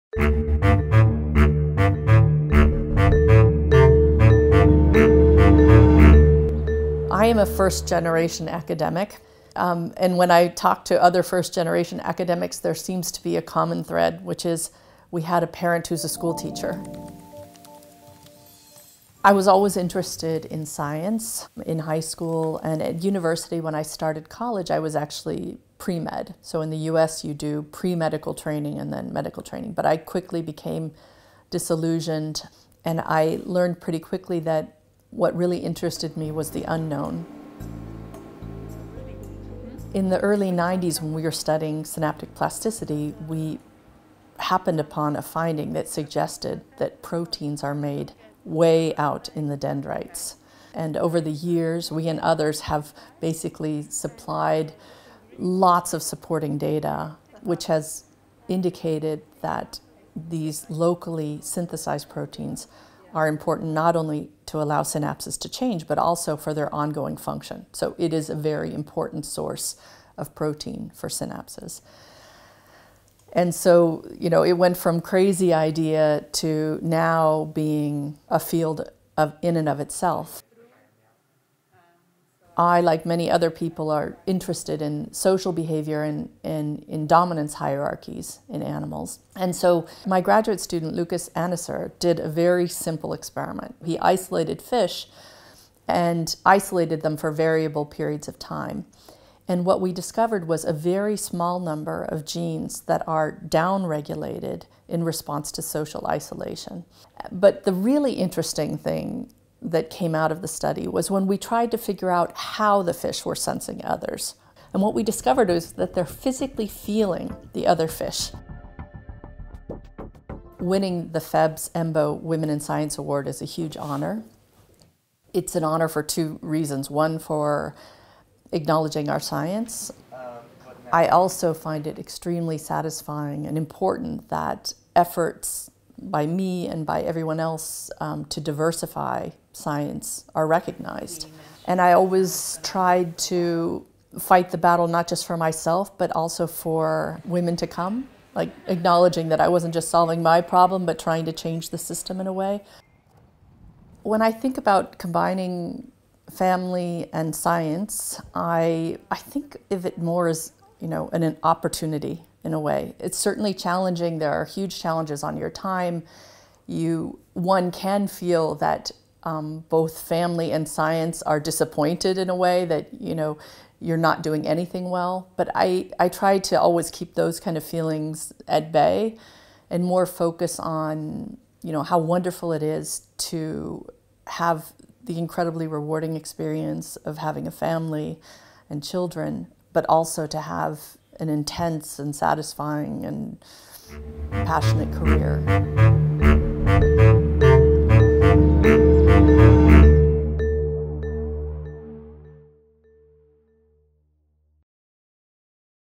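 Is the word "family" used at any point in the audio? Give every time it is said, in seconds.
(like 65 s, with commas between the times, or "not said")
156 s, 170 s, 187 s.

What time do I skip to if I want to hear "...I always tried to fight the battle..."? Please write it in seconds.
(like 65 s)
141 s.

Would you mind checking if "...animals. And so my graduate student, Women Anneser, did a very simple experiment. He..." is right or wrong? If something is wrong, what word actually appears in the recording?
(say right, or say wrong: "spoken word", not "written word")
wrong: "Lukas", not "Women".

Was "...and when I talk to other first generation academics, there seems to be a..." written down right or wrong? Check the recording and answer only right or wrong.
right.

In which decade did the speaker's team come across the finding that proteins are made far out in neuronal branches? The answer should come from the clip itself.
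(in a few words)
Early 90s.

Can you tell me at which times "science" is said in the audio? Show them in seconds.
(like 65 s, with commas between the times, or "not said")
20 s, 122 s, 129 s, 139 s, 157 s, 170 s.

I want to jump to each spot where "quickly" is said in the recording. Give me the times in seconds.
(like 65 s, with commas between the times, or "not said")
29 s, 33 s.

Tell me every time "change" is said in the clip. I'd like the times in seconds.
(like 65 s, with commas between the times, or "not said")
65 s, 151 s.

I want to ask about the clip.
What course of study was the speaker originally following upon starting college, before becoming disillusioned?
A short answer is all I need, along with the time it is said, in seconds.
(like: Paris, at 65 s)
Pre med, at 25 s.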